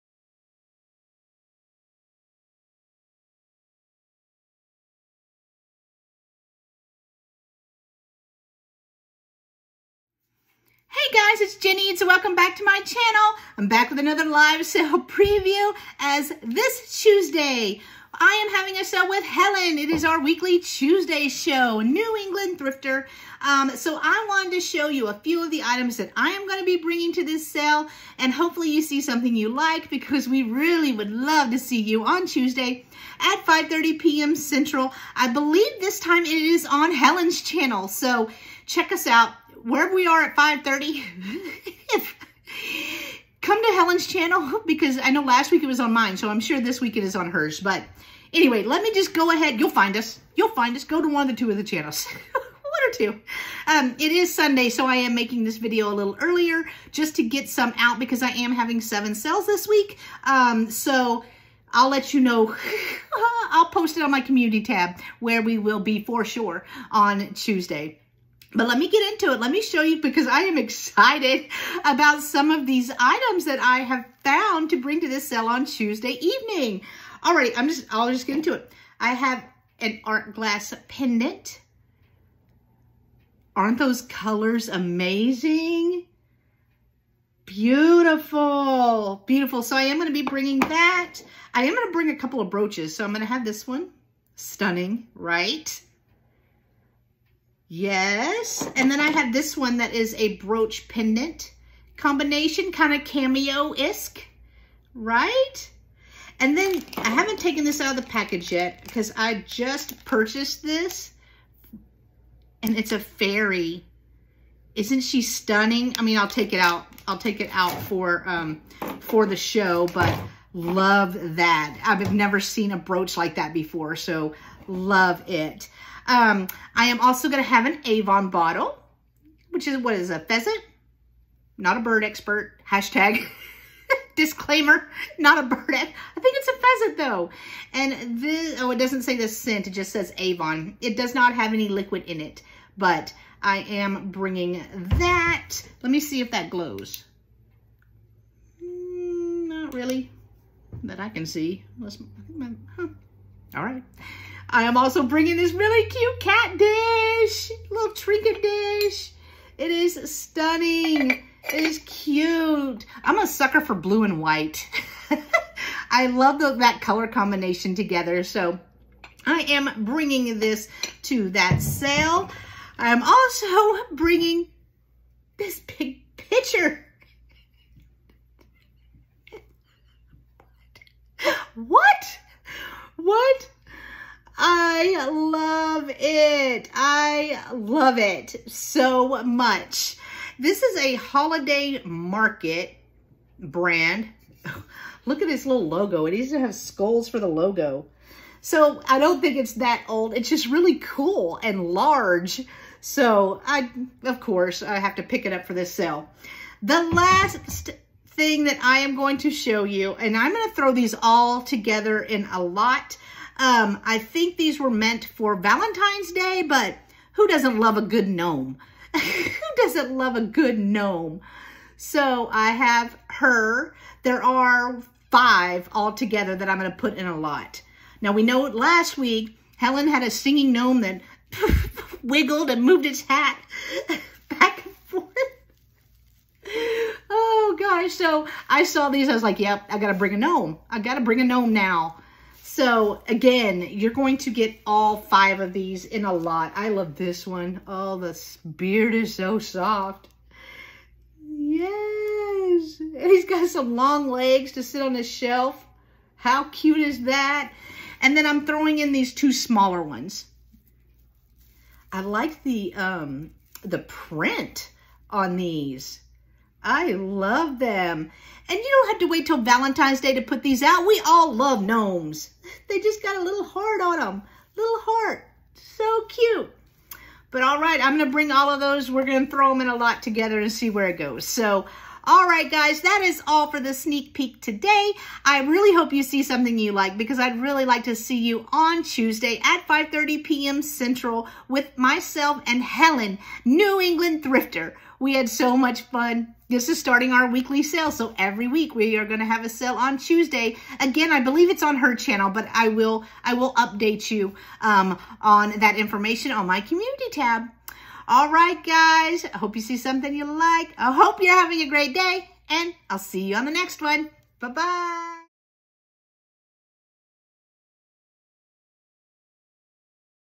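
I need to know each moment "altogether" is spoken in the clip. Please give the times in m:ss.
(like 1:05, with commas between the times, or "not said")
3:45.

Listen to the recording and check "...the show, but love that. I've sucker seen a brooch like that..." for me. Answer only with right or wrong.
wrong.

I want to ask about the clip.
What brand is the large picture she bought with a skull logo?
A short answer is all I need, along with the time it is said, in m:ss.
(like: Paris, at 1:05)
Holiday market, at 3:10.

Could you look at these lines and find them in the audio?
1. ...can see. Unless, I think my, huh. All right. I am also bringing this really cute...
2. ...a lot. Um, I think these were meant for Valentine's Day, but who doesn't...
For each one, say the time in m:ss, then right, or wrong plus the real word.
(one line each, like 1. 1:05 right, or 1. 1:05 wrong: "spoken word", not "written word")
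1. 2:31 right
2. 3:32 right.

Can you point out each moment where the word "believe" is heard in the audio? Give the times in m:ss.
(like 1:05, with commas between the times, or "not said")
0:35, 5:01.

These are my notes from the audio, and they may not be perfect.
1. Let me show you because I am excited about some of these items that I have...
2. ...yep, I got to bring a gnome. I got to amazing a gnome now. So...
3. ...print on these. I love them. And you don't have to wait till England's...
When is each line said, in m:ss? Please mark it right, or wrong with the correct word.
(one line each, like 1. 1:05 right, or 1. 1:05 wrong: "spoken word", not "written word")
1. 1:09 right
2. 3:59 wrong: "bring", not "amazing"
3. 4:23 wrong: "Valentine", not "England".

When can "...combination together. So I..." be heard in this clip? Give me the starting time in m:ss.
2:47.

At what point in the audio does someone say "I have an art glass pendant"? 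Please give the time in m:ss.
1:18.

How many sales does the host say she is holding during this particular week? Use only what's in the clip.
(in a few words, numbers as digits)
7.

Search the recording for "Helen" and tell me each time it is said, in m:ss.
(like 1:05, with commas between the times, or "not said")
0:19, 0:36, 0:43, 3:49, 4:52.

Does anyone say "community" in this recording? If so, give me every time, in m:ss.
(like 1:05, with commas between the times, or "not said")
1:04, 5:06.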